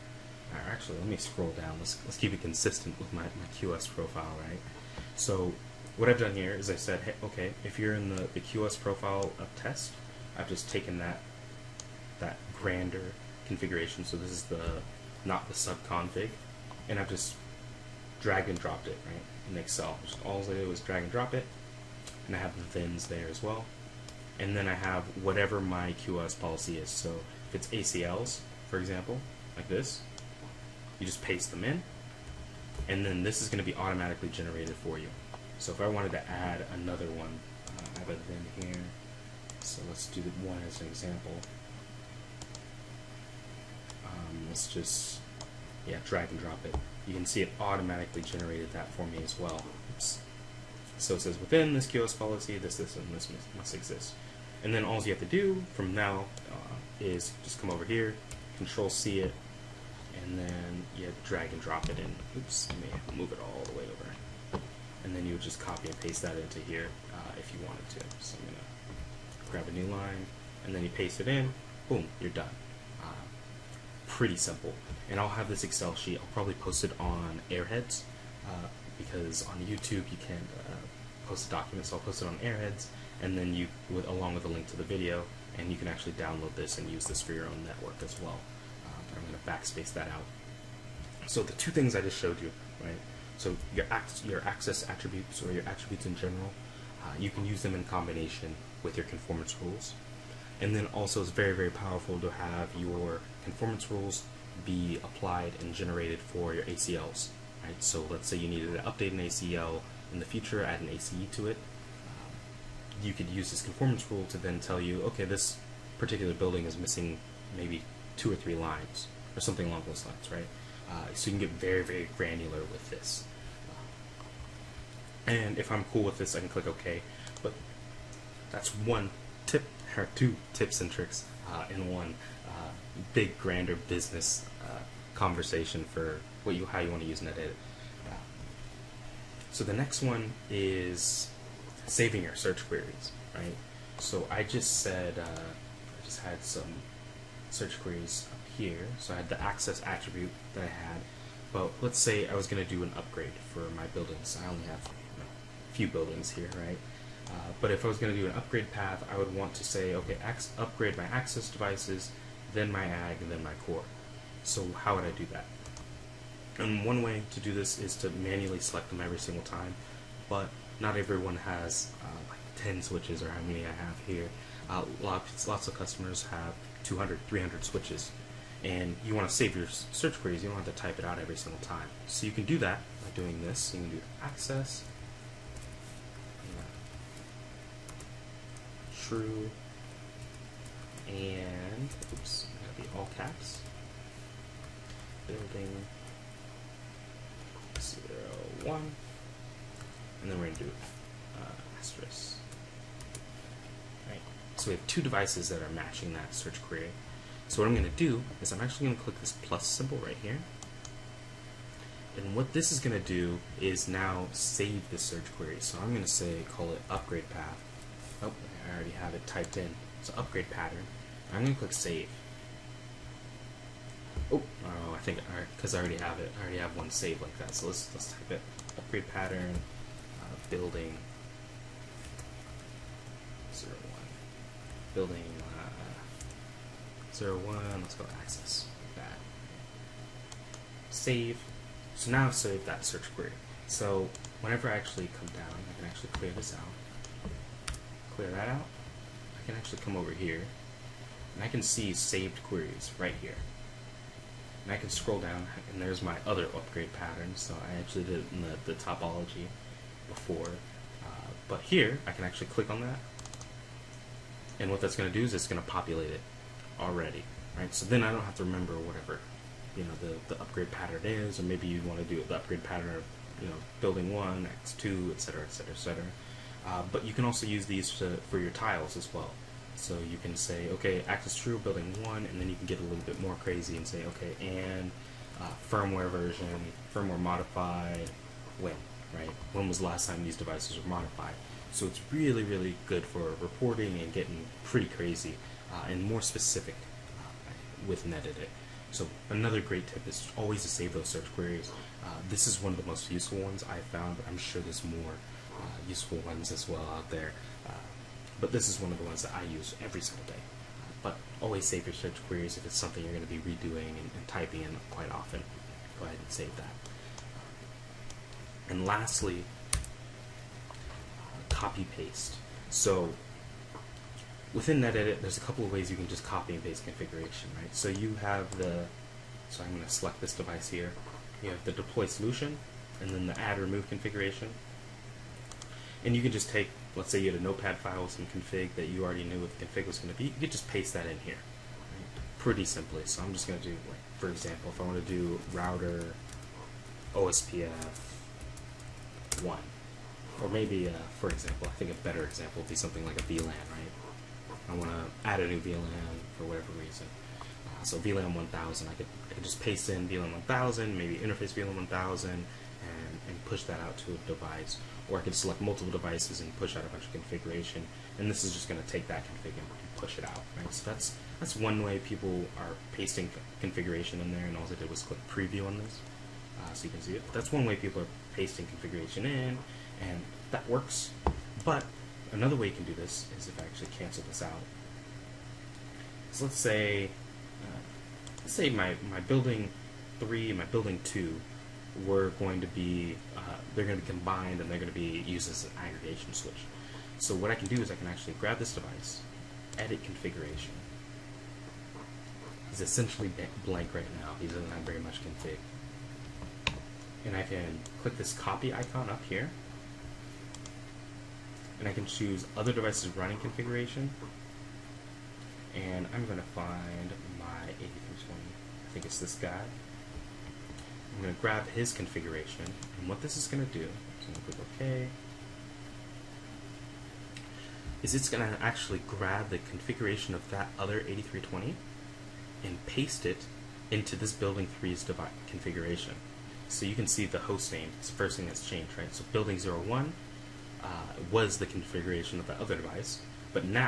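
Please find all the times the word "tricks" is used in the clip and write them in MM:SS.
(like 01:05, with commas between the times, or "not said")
02:10.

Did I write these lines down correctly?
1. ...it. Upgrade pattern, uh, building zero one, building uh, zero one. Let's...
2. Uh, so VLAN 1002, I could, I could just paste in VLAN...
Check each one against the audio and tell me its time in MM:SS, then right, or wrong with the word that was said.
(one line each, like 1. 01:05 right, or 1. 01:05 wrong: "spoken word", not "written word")
1. 03:48 right
2. 05:57 wrong: "1000", not "1002".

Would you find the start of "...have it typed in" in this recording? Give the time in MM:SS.
03:38.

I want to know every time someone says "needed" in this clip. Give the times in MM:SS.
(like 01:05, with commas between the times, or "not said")
01:48.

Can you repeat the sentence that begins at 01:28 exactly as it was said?
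Uh, I'm going to backspace that out.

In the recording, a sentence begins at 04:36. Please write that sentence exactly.
Uh, but you can also use these to, for your tiles as well.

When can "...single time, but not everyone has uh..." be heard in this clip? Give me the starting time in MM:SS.
02:49.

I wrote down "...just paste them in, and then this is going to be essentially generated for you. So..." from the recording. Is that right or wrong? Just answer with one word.
wrong.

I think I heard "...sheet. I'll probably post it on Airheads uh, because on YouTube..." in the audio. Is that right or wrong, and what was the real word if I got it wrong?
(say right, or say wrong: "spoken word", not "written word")
right.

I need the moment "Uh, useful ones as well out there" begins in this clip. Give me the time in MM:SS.
05:05.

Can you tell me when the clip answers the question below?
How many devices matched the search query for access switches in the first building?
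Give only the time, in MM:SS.
03:24.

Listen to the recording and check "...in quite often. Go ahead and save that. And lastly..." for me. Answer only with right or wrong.
right.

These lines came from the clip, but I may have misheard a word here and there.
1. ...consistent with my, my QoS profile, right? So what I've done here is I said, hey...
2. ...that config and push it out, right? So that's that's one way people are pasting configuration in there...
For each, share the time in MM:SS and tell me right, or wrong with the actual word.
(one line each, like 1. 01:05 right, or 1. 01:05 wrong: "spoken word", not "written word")
1. 00:02 right
2. 06:09 right.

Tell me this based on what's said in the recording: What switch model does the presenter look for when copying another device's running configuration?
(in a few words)
8320.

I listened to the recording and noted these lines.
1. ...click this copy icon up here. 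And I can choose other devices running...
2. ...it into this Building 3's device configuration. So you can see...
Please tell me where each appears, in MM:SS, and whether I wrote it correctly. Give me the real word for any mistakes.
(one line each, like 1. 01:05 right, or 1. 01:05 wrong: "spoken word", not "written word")
1. 06:48 right
2. 07:13 right.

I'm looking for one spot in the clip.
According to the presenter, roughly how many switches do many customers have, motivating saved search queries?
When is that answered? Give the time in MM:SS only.
02:56.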